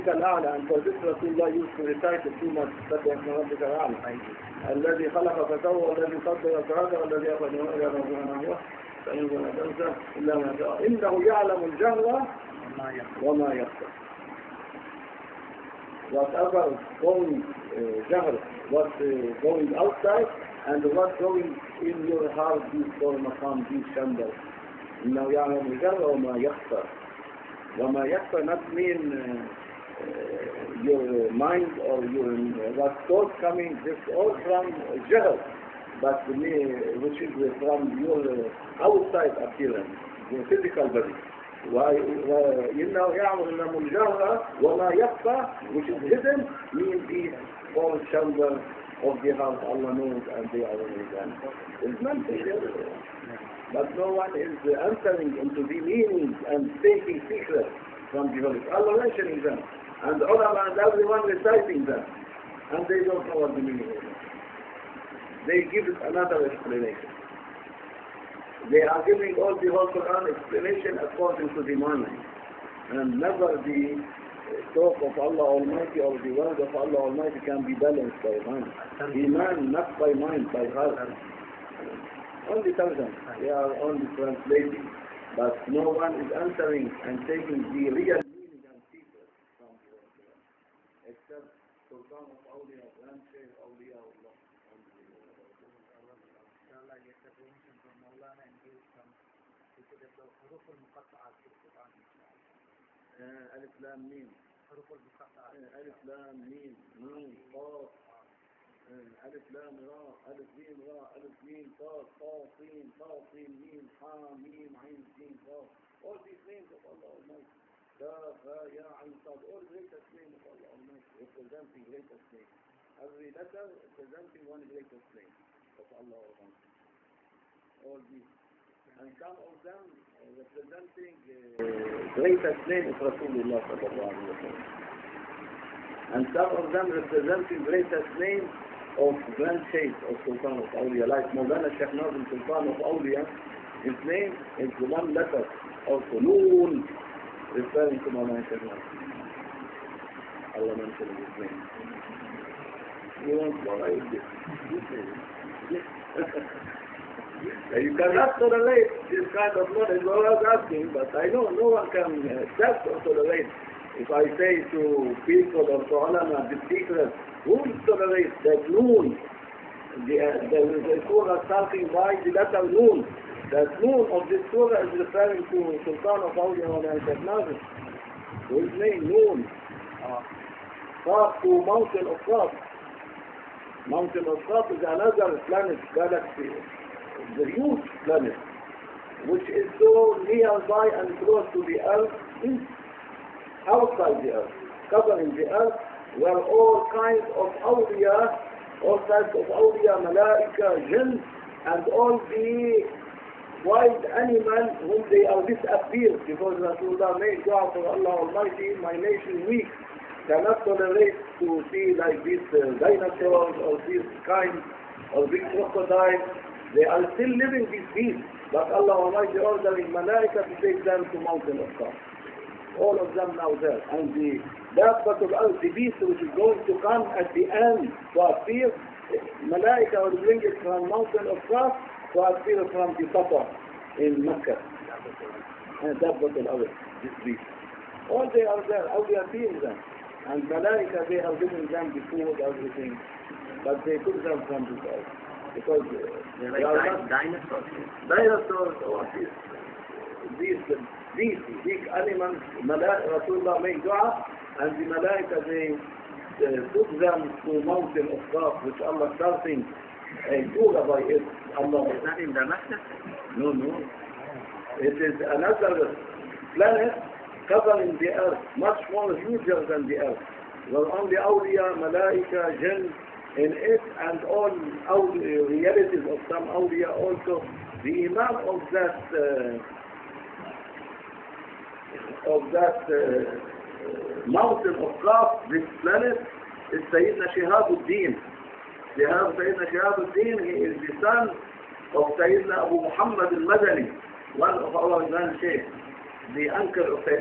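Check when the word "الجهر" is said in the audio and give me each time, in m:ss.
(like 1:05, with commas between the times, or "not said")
0:11, 0:25, 0:43.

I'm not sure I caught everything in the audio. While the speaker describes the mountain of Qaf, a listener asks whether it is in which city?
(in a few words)
Damascus.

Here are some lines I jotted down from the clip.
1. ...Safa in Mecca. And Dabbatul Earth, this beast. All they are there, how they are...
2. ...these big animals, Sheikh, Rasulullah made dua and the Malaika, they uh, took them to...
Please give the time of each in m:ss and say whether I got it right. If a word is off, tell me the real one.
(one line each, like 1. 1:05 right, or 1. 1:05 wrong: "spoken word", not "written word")
1. 3:53 right
2. 4:11 wrong: "Malaika", not "Sheikh".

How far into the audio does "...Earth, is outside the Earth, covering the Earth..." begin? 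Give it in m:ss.
3:11.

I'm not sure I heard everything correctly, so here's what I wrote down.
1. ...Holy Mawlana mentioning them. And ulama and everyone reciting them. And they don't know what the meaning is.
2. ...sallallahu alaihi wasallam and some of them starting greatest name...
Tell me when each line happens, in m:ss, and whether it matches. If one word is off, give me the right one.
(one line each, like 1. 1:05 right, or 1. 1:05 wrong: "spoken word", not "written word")
1. 0:58 wrong: "Allah", not "Mawlana"
2. 2:13 wrong: "representing", not "starting".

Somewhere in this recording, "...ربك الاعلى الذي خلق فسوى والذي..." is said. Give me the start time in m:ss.
0:03.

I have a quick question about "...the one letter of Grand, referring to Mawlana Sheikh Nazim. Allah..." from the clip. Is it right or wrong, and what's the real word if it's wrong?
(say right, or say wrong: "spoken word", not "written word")
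wrong: "Sulun", not "Grand".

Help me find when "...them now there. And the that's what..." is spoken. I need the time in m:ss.
3:43.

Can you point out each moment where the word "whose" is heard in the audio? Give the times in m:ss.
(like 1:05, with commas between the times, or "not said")
2:58.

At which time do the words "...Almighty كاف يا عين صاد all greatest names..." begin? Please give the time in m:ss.
1:57.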